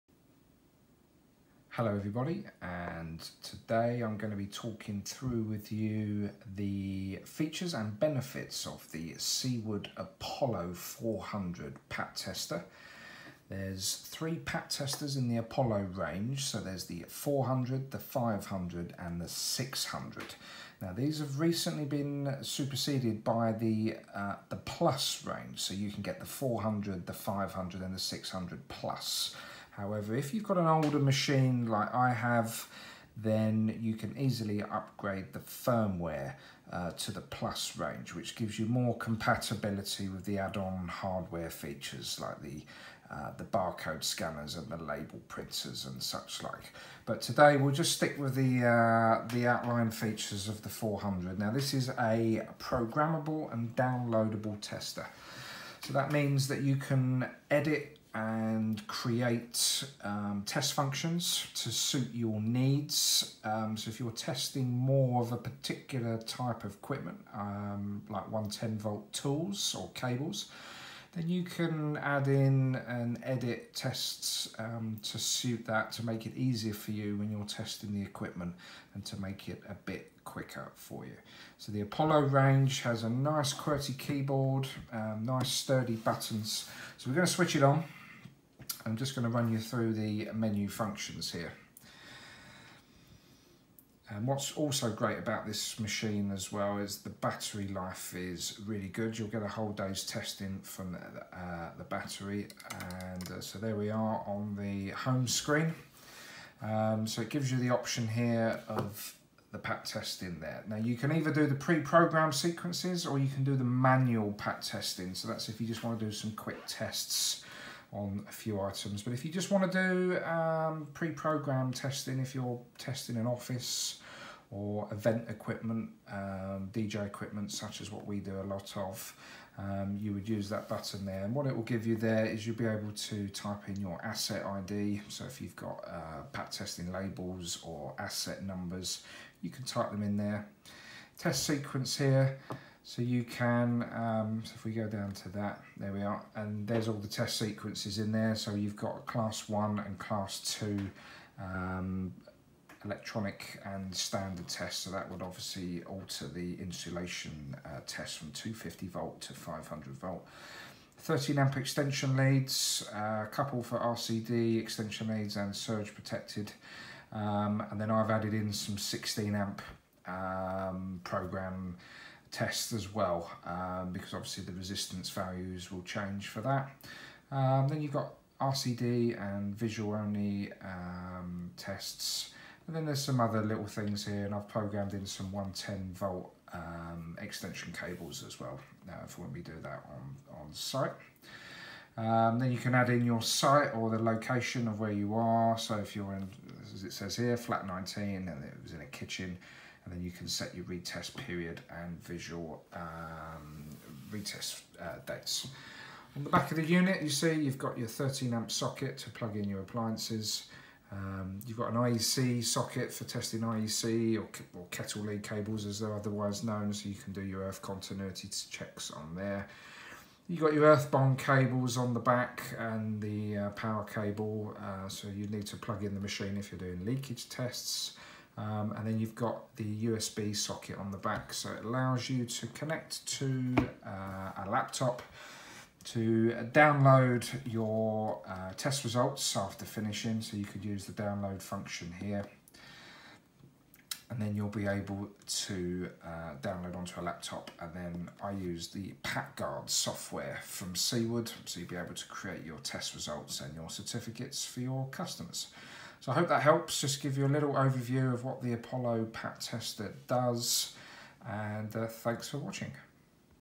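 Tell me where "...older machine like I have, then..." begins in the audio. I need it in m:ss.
0:30.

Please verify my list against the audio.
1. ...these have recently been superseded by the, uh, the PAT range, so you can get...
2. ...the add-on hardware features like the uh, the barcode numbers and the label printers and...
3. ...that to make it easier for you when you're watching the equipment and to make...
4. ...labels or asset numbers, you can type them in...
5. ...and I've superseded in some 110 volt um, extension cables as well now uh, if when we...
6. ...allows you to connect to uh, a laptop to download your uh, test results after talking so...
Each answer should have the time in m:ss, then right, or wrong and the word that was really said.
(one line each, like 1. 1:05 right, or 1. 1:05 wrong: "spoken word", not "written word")
1. 0:20 wrong: "Plus", not "PAT"
2. 0:40 wrong: "scanners", not "numbers"
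3. 1:15 wrong: "testing", not "watching"
4. 2:16 right
5. 3:04 wrong: "programmed", not "superseded"
6. 3:51 wrong: "finishing", not "talking".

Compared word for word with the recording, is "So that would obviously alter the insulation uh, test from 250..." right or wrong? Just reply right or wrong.
right.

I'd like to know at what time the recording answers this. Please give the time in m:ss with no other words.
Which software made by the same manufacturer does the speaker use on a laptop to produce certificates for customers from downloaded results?
4:09.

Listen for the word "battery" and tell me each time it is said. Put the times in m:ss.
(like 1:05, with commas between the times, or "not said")
1:37, 1:41.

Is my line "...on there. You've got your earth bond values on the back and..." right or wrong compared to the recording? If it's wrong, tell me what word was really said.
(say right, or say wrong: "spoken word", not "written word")
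wrong: "cables", not "values".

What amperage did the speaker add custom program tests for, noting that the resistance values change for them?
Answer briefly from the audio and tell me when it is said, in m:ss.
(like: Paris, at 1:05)
16 amp, at 2:48.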